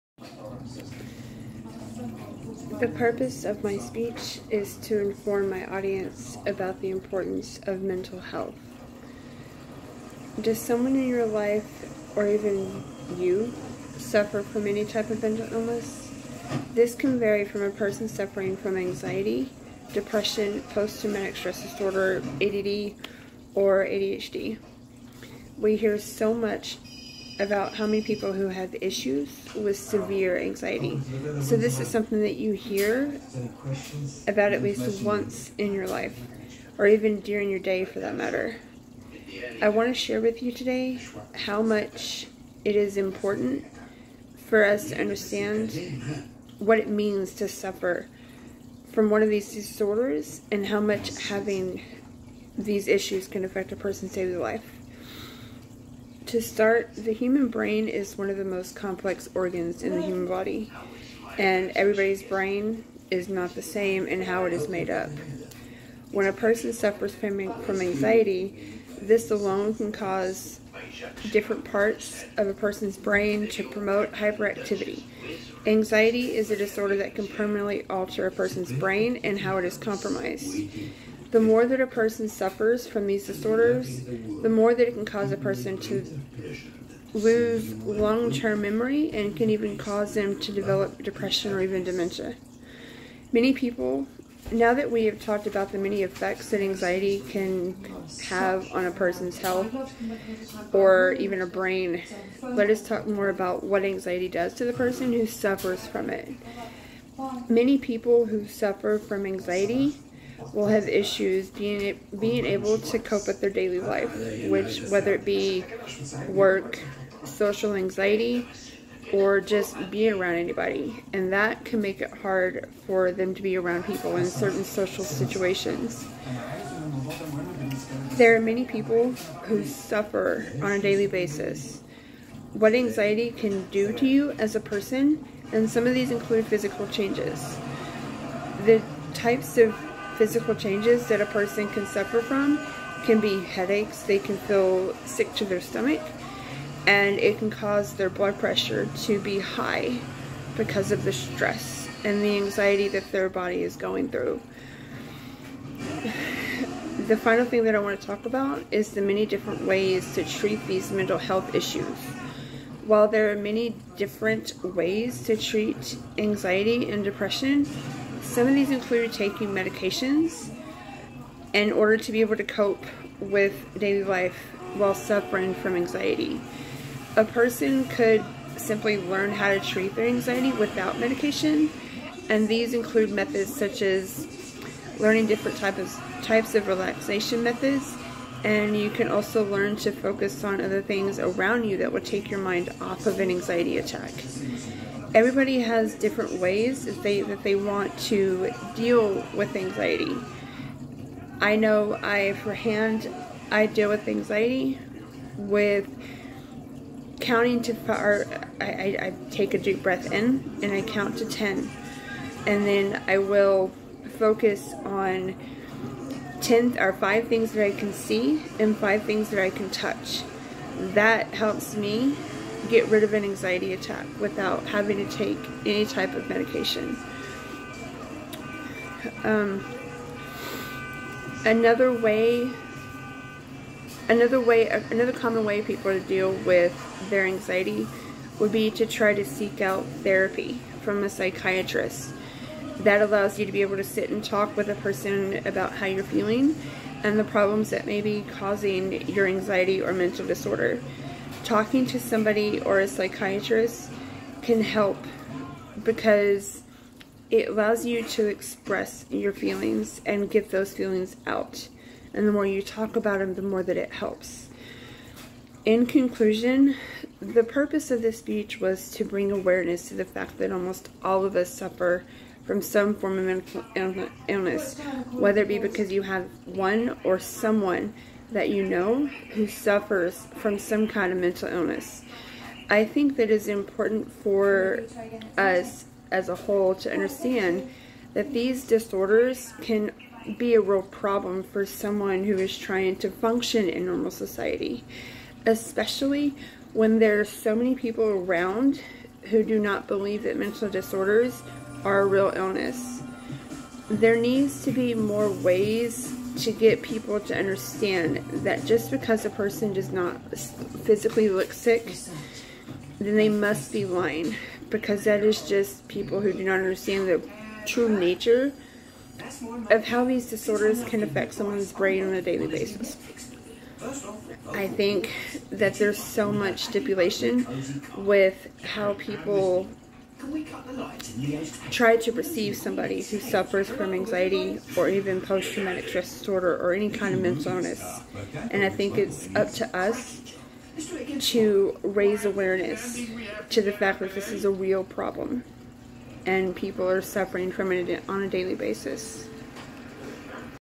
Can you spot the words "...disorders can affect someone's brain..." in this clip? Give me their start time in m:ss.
5:20.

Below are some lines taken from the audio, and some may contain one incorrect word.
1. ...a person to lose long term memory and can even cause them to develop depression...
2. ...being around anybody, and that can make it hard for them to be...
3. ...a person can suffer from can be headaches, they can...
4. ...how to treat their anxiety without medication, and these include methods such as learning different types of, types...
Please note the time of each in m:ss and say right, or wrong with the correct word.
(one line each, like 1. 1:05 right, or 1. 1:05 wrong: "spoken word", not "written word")
1. 1:25 right
2. 1:59 right
3. 2:21 right
4. 2:59 right.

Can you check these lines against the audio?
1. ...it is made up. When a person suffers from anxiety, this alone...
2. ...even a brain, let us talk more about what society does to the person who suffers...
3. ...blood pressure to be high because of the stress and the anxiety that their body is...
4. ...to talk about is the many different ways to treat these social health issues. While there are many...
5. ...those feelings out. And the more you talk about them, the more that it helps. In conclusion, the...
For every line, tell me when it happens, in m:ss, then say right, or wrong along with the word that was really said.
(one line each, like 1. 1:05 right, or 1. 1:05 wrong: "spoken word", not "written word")
1. 1:04 right
2. 1:41 wrong: "anxiety", not "society"
3. 2:28 right
4. 2:37 wrong: "mental", not "social"
5. 4:20 right.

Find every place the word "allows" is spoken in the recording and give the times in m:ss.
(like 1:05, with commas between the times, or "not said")
4:03, 4:17.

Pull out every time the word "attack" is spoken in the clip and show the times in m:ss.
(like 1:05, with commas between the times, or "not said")
3:13, 3:43.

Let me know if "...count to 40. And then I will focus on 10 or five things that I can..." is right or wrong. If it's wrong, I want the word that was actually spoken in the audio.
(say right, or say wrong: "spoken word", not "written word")
wrong: "10", not "40".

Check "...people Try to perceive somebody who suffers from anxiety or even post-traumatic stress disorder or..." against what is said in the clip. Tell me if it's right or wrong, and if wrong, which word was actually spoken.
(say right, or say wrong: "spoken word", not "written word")
right.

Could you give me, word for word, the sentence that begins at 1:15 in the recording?
Anxiety is a disorder that can permanently alter a person's brain and how it is compromised.